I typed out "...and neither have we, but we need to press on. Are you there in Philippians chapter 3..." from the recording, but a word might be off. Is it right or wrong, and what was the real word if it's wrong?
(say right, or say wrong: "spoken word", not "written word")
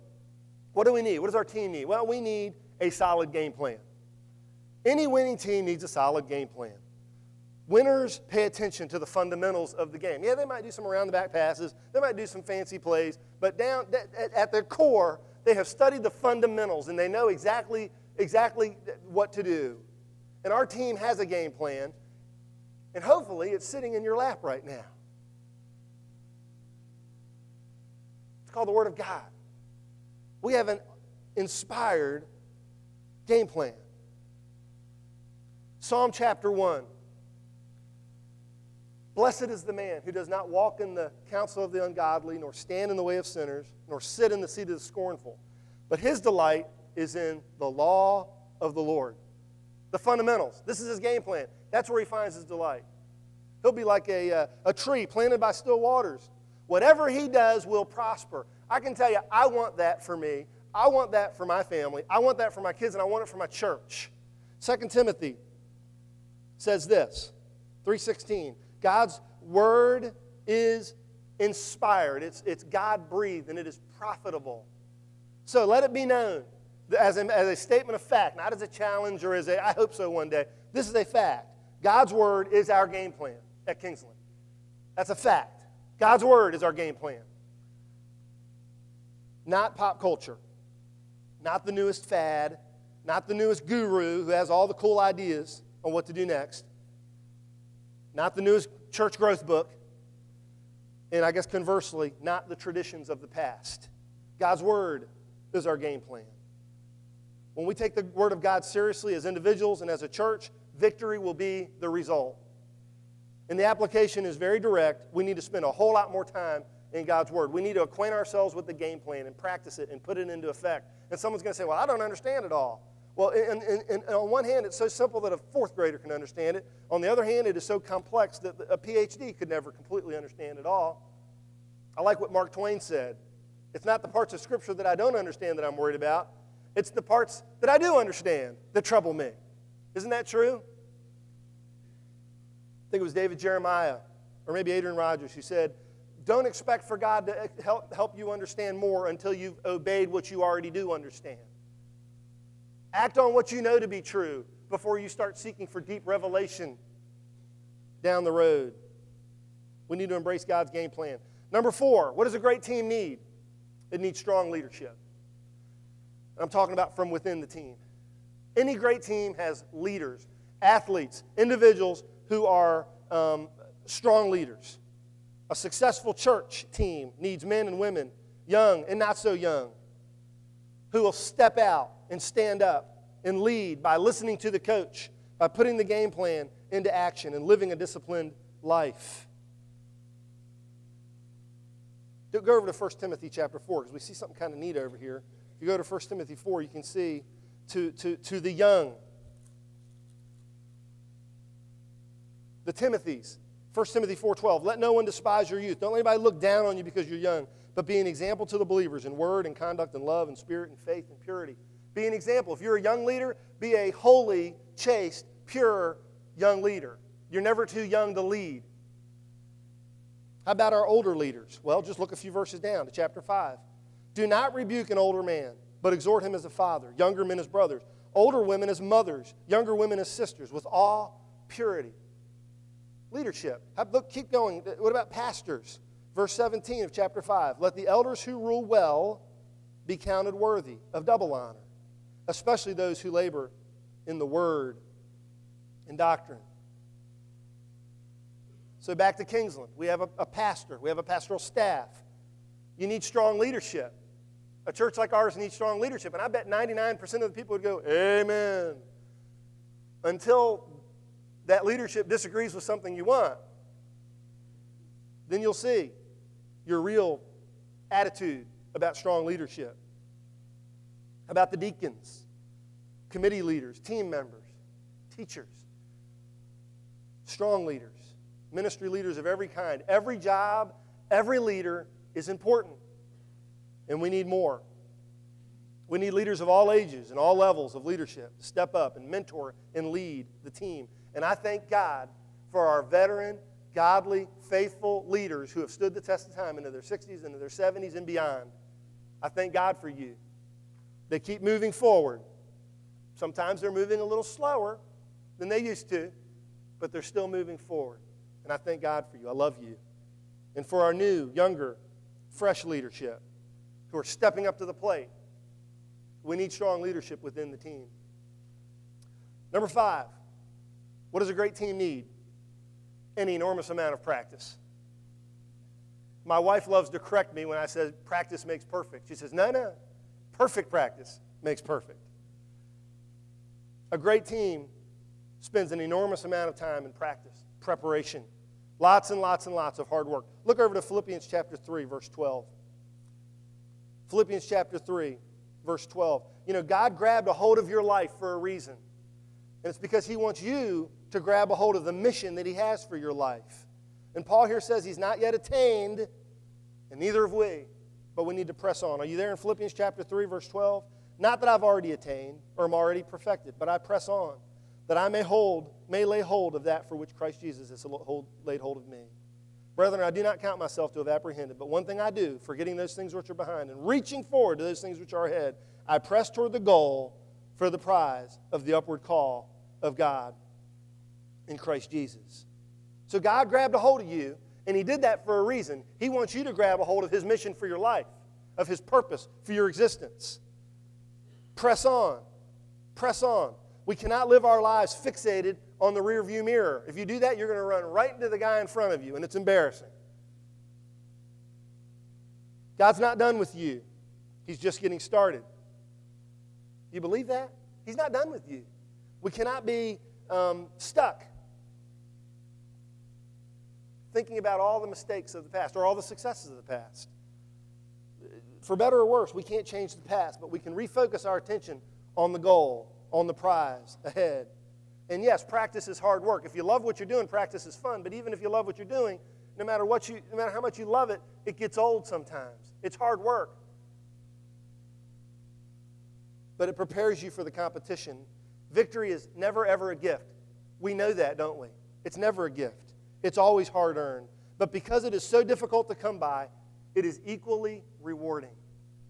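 right.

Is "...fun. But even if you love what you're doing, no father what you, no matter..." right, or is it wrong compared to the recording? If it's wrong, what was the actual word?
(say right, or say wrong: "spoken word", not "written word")
wrong: "matter", not "father".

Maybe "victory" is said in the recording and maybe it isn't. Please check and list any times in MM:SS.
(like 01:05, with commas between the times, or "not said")
01:50, 07:18.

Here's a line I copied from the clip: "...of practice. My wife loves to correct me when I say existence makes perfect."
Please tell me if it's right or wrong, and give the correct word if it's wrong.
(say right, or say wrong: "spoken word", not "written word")
wrong: "practice", not "existence".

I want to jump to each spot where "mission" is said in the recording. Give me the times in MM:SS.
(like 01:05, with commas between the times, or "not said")
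05:51, 06:27.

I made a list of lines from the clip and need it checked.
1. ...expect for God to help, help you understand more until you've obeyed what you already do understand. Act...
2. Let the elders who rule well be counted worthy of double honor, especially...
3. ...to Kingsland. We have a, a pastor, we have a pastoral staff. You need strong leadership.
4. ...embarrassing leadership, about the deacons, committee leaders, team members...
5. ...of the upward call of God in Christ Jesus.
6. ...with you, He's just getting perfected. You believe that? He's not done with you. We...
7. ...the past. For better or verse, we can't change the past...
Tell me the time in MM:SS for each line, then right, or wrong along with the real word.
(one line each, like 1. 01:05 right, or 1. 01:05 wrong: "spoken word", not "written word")
1. 02:26 right
2. 03:57 right
3. 04:09 right
4. 04:28 wrong: "strong", not "embarrassing"
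5. 06:18 right
6. 06:43 wrong: "started", not "perfected"
7. 06:56 wrong: "worse", not "verse".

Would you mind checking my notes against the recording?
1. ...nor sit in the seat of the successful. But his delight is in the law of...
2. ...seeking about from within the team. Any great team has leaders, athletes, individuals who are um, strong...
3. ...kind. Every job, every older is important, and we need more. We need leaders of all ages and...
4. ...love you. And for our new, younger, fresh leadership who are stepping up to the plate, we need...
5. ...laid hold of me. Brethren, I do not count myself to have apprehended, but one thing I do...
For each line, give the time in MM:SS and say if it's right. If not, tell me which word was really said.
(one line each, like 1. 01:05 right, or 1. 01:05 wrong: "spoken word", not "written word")
1. 00:43 wrong: "scornful", not "successful"
2. 02:46 wrong: "talking", not "seeking"
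3. 04:39 wrong: "leader", not "older"
4. 05:09 right
5. 06:08 right.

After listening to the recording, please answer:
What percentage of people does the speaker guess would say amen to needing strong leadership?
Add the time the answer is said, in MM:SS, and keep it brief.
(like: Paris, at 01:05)
99%, at 04:16.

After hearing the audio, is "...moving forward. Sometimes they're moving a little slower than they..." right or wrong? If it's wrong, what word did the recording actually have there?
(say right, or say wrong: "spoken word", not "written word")
right.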